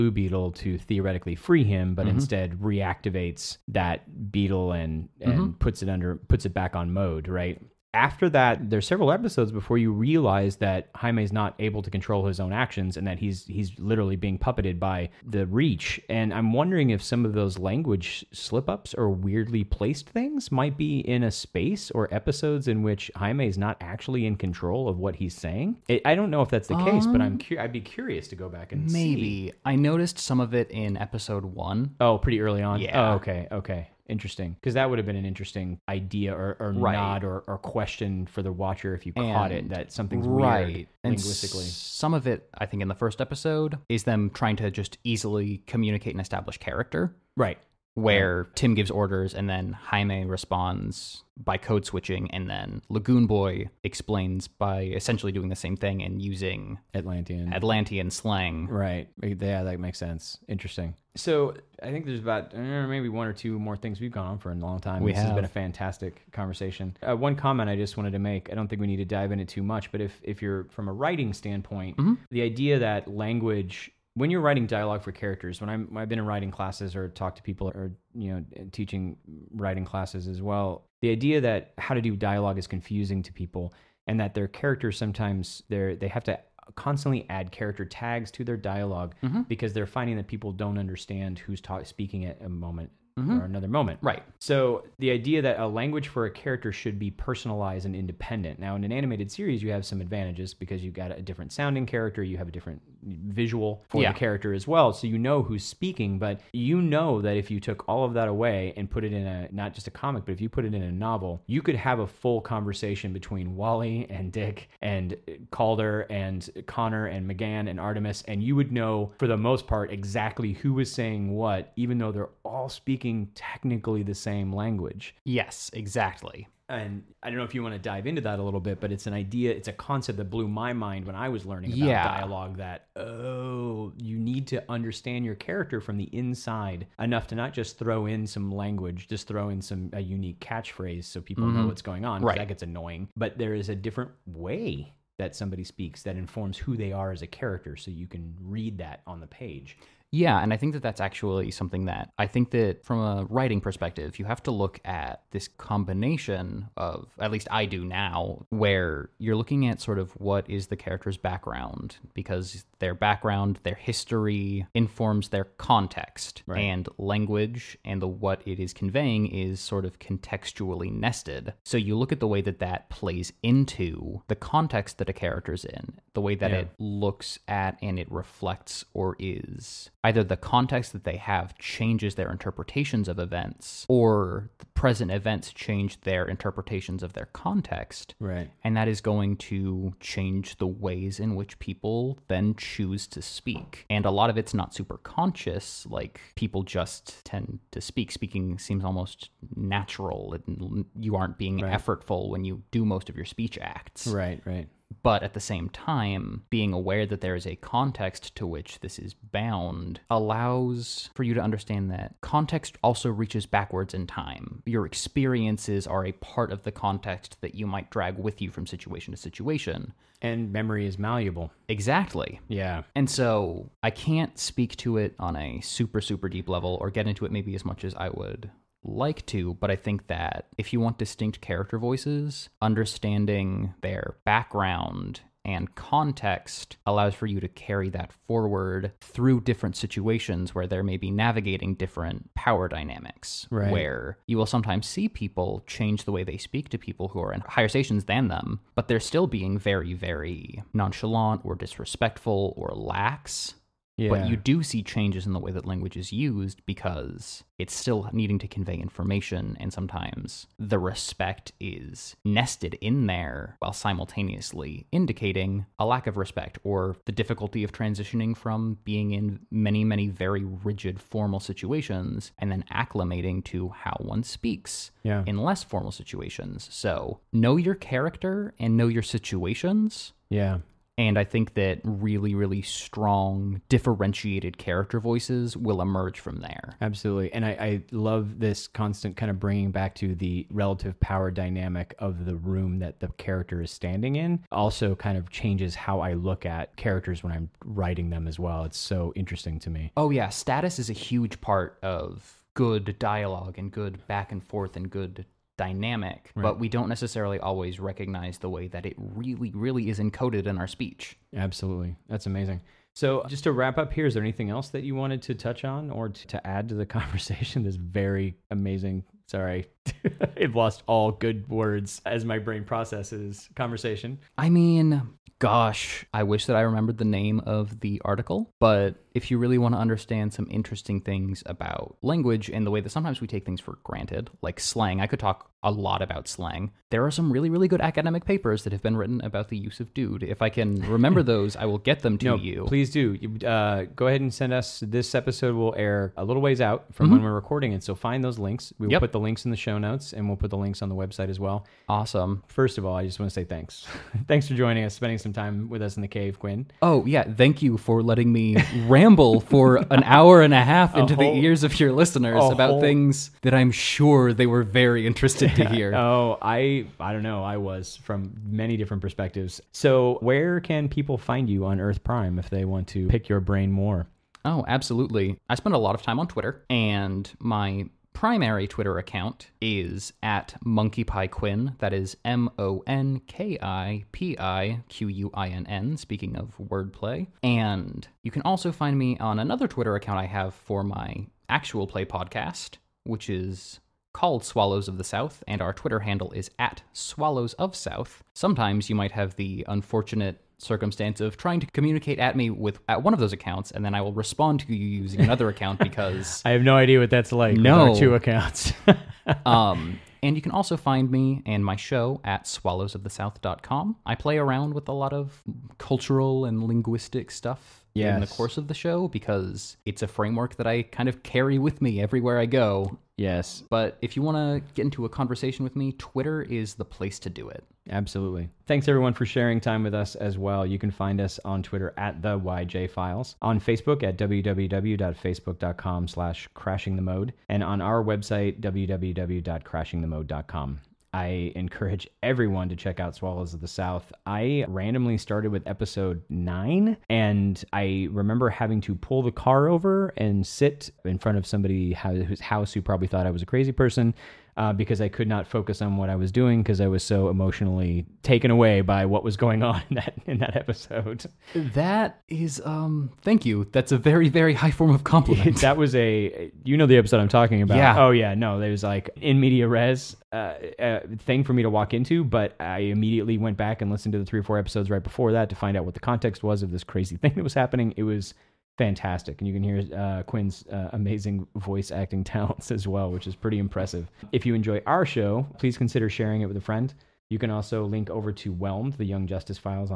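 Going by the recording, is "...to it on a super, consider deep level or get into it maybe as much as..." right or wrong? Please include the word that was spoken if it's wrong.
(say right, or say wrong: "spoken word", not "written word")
wrong: "super", not "consider".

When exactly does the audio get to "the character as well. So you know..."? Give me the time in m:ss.
1:44.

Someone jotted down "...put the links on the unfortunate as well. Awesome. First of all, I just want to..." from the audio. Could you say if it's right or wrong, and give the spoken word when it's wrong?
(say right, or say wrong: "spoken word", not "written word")
wrong: "website", not "unfortunate".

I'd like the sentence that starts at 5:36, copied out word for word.
There are some really, really good academic papers that have been written about the use of dude.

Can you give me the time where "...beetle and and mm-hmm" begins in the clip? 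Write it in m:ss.
0:04.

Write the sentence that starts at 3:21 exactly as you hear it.
effortful when you do most of your speech acts.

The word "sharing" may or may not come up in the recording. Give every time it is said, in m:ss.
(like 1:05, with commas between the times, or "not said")
7:09, 8:06.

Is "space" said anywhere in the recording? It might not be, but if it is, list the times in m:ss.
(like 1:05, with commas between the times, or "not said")
0:21.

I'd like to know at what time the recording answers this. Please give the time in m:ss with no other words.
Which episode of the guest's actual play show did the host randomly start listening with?
7:25.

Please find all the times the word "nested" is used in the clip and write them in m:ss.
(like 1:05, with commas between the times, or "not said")
2:50, 4:22.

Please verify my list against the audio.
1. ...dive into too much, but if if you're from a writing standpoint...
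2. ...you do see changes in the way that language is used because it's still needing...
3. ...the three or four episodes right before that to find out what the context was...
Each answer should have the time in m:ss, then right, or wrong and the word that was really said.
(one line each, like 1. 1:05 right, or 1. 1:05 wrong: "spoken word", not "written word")
1. 1:09 right
2. 4:14 right
3. 7:54 right.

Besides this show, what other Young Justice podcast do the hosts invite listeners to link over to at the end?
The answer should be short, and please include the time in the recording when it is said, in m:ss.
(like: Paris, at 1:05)
Whelmed, at 8:08.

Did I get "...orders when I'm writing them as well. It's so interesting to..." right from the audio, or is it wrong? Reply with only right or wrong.
wrong.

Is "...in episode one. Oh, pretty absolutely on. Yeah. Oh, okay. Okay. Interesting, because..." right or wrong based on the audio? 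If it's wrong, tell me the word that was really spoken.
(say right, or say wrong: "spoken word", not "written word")
wrong: "early", not "absolutely".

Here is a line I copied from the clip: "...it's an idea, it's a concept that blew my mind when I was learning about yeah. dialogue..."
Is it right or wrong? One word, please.
right.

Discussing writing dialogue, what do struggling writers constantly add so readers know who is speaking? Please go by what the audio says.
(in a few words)
Character tags.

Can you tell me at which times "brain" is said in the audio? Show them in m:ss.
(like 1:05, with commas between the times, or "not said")
5:22, 6:13.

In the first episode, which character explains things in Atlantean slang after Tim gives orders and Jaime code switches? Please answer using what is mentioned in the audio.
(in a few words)
Lagoon Boy.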